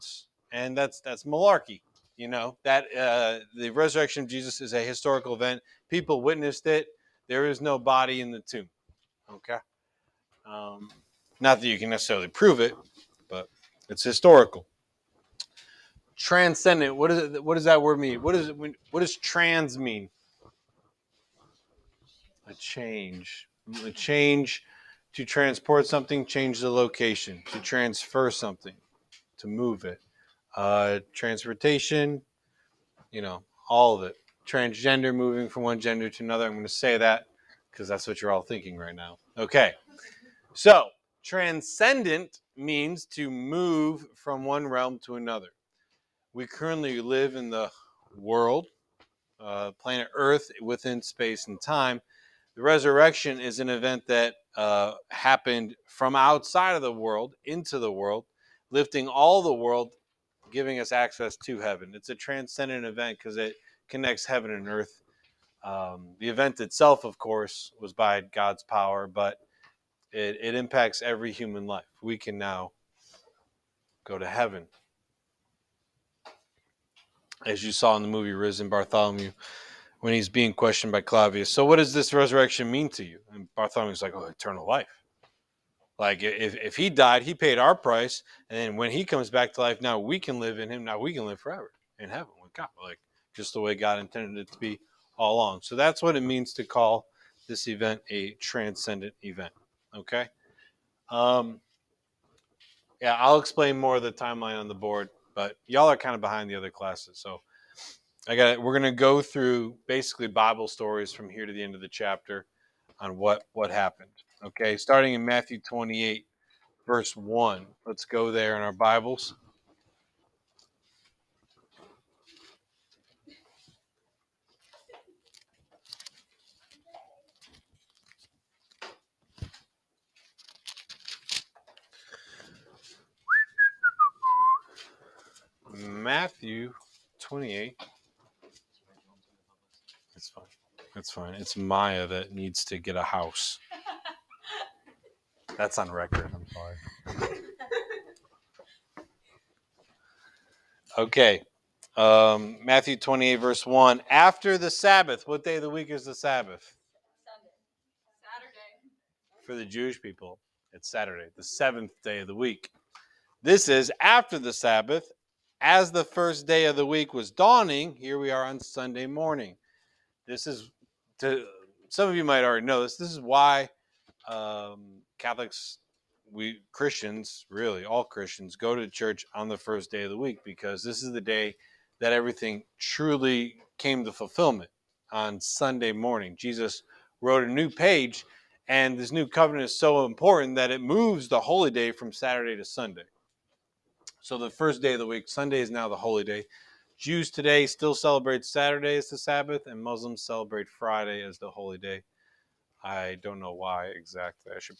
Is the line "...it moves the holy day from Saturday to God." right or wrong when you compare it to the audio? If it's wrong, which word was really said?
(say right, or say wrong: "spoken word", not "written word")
wrong: "Sunday", not "God".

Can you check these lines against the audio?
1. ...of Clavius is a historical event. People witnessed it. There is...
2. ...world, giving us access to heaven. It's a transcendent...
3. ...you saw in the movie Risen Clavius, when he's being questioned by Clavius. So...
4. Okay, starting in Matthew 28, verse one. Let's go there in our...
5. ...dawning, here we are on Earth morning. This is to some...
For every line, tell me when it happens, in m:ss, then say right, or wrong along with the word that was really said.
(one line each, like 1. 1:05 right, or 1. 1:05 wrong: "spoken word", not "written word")
1. 0:04 wrong: "Jesus", not "Clavius"
2. 0:59 right
3. 1:17 wrong: "Bartholomew", not "Clavius"
4. 1:54 right
5. 2:47 wrong: "Sunday", not "Earth".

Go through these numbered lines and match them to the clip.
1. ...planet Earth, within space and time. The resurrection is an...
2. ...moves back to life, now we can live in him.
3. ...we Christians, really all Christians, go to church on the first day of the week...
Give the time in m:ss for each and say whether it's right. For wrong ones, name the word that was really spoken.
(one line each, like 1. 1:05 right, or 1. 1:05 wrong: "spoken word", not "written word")
1. 0:49 right
2. 1:29 wrong: "comes", not "moves"
3. 2:56 right.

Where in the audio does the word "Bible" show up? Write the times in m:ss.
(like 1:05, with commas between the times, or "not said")
1:50, 1:58.